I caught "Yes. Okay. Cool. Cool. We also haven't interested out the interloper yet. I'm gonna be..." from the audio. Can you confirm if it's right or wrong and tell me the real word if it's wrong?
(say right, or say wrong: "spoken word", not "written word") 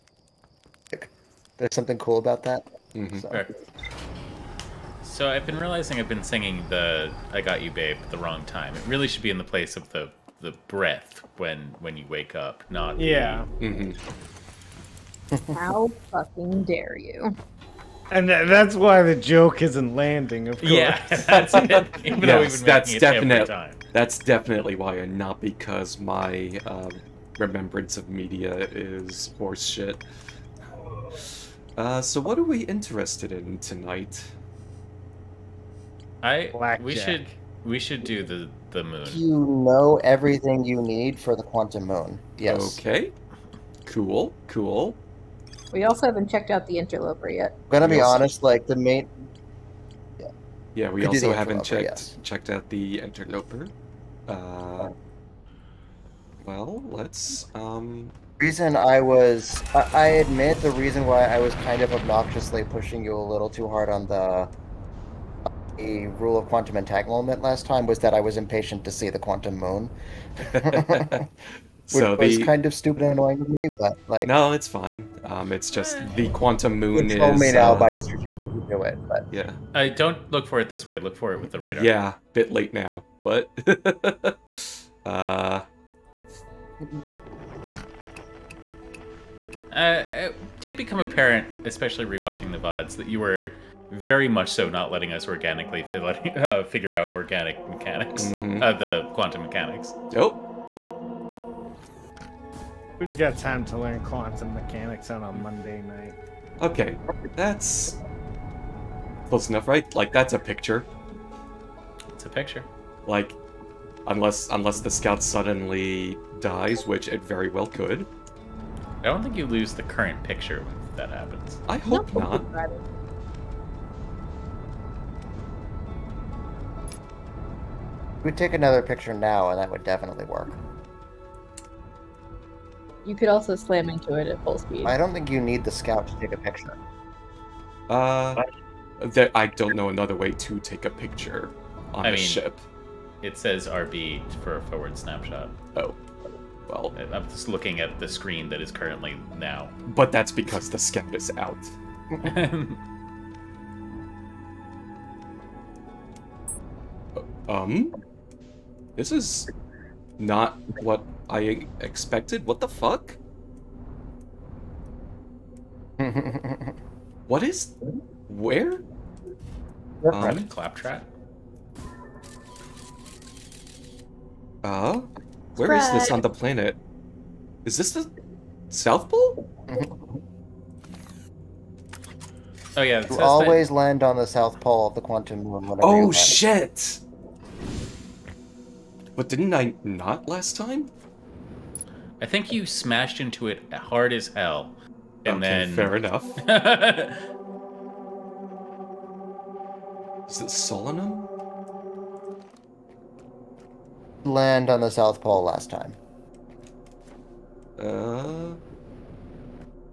wrong: "checked", not "interested".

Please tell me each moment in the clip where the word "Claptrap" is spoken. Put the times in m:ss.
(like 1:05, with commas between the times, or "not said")
2:50.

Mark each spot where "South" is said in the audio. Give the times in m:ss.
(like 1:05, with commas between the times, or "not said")
2:58, 3:04, 3:24.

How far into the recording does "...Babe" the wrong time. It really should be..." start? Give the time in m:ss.
0:07.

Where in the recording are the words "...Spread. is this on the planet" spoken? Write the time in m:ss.
2:55.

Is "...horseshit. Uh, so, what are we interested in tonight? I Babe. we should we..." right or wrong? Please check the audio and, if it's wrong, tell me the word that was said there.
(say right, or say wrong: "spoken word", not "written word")
wrong: "Blackjack", not "Babe".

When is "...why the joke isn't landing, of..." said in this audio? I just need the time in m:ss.
0:18.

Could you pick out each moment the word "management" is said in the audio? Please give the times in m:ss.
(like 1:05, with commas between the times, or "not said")
not said.